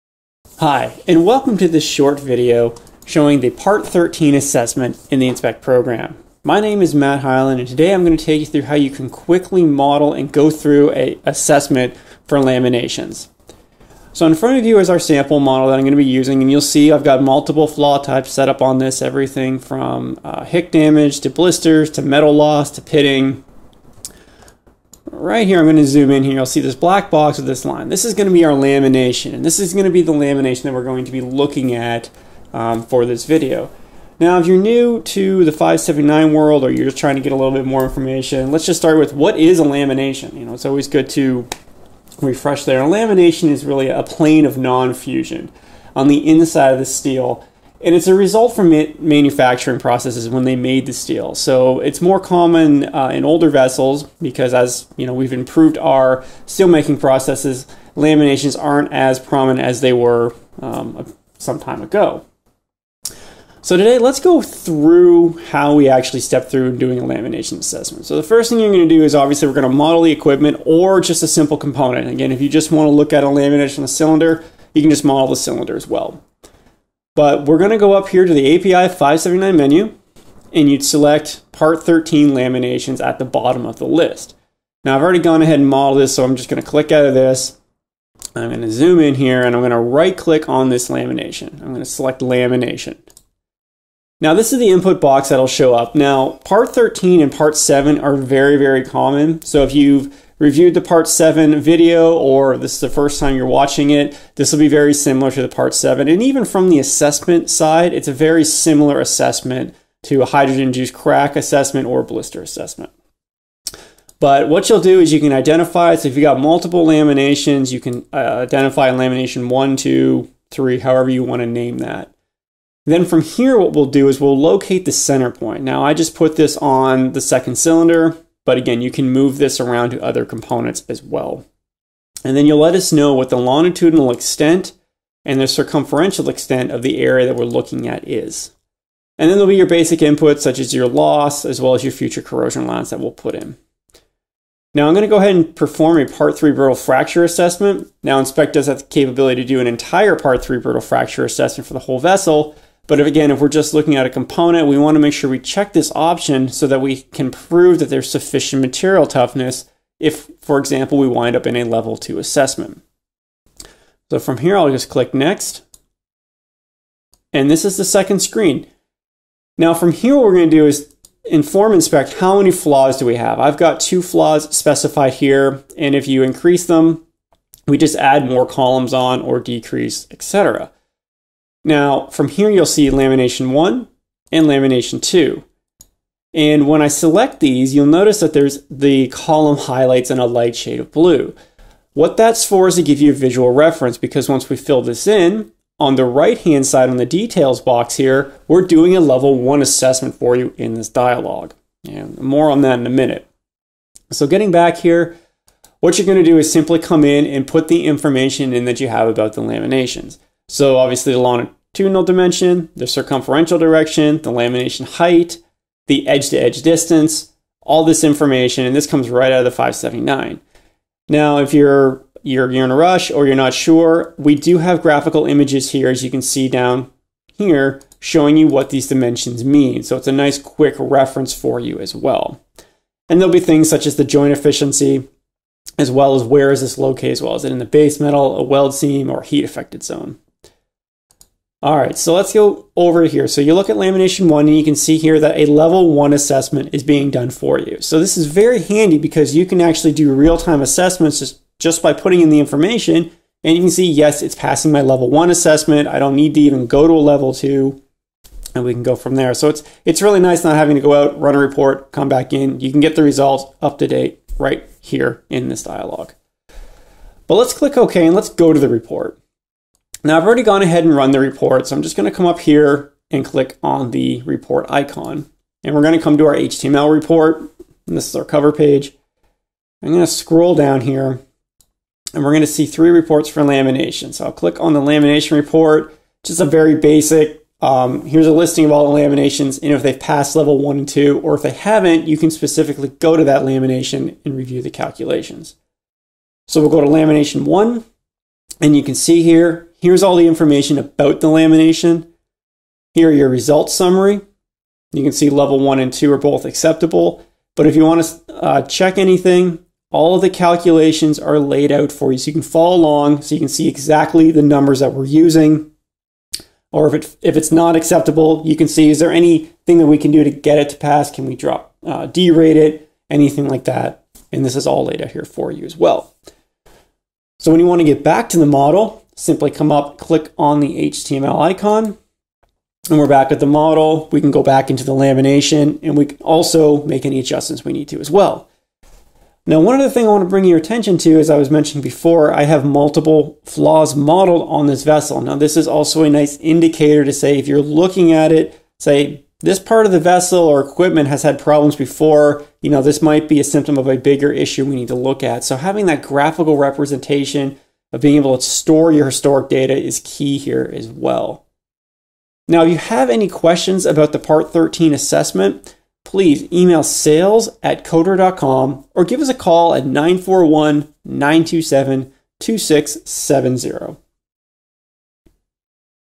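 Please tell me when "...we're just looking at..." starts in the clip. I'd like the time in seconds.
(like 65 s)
153 s.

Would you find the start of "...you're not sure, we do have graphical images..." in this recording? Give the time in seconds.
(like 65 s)
223 s.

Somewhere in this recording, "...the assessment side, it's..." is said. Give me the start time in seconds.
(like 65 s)
106 s.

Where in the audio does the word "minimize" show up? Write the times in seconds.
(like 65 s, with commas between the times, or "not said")
not said.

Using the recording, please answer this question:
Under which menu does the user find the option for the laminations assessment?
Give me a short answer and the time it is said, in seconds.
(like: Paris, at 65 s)
API 579, at 78 s.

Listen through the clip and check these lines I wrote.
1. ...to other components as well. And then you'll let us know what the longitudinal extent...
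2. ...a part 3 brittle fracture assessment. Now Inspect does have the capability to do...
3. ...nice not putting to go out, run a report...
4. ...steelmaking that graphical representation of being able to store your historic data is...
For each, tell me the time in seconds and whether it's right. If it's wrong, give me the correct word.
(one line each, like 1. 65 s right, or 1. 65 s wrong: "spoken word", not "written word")
1. 129 s right
2. 145 s right
3. 260 s wrong: "having", not "putting"
4. 355 s wrong: "having", not "steelmaking".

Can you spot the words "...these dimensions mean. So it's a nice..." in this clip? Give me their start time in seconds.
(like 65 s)
228 s.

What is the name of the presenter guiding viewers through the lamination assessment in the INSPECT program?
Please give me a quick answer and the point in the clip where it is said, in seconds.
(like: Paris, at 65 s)
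Matt Hyland, at 6 s.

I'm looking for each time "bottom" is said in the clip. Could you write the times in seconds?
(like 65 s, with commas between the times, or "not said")
83 s.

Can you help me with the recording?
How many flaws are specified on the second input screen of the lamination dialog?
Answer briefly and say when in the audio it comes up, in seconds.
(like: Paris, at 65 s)
2, at 173 s.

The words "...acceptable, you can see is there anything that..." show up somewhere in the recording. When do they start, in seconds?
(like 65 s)
317 s.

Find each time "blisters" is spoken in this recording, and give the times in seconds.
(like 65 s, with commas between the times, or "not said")
21 s, 112 s.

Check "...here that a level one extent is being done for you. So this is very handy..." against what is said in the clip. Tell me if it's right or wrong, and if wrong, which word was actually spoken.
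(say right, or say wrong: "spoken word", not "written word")
wrong: "assessment", not "extent".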